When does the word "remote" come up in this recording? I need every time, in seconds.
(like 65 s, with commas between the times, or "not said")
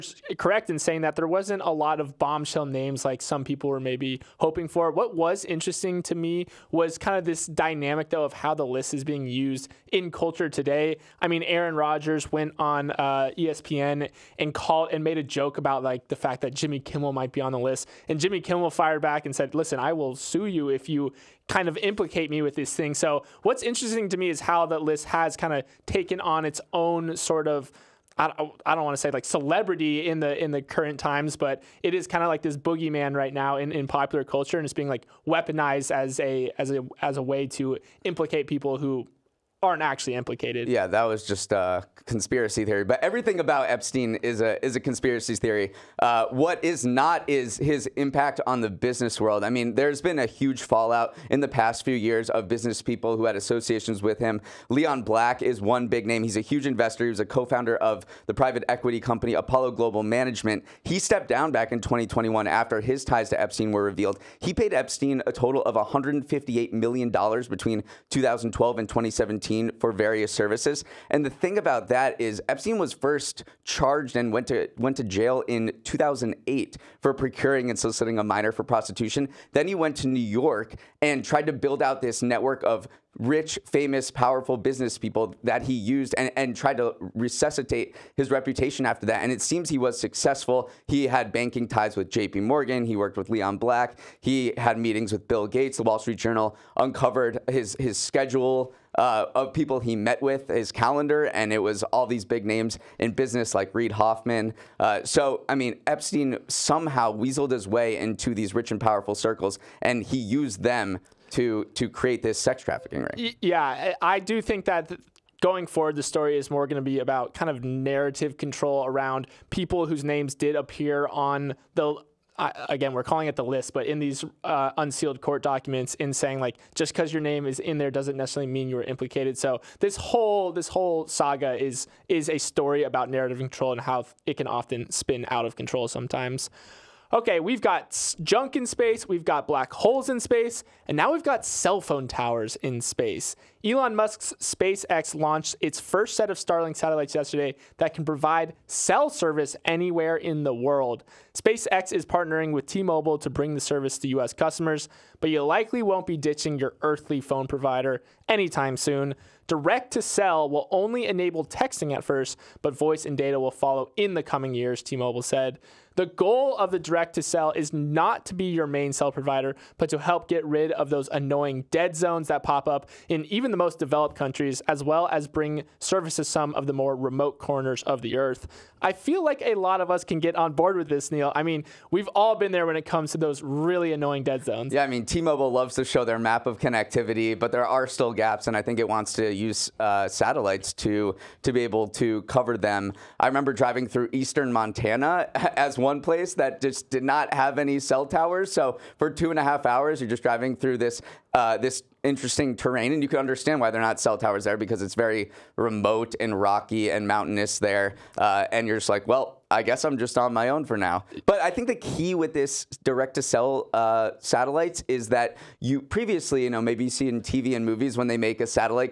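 176 s, 205 s.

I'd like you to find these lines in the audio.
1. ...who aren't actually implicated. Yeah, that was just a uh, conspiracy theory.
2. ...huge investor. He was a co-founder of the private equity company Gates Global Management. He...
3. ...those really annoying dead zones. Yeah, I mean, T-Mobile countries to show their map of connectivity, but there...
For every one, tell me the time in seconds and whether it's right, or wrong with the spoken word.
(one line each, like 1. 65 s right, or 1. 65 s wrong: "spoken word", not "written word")
1. 38 s right
2. 56 s wrong: "Apollo", not "Gates"
3. 183 s wrong: "loves", not "countries".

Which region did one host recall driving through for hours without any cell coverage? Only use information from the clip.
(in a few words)
Eastern Montana.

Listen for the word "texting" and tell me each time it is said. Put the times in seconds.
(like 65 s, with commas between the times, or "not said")
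161 s.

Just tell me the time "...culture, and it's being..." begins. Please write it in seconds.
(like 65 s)
34 s.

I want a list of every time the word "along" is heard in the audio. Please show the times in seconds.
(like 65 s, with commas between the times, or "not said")
not said.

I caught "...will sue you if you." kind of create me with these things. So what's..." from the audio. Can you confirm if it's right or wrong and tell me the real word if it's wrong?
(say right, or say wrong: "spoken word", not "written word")
wrong: "implicate", not "create".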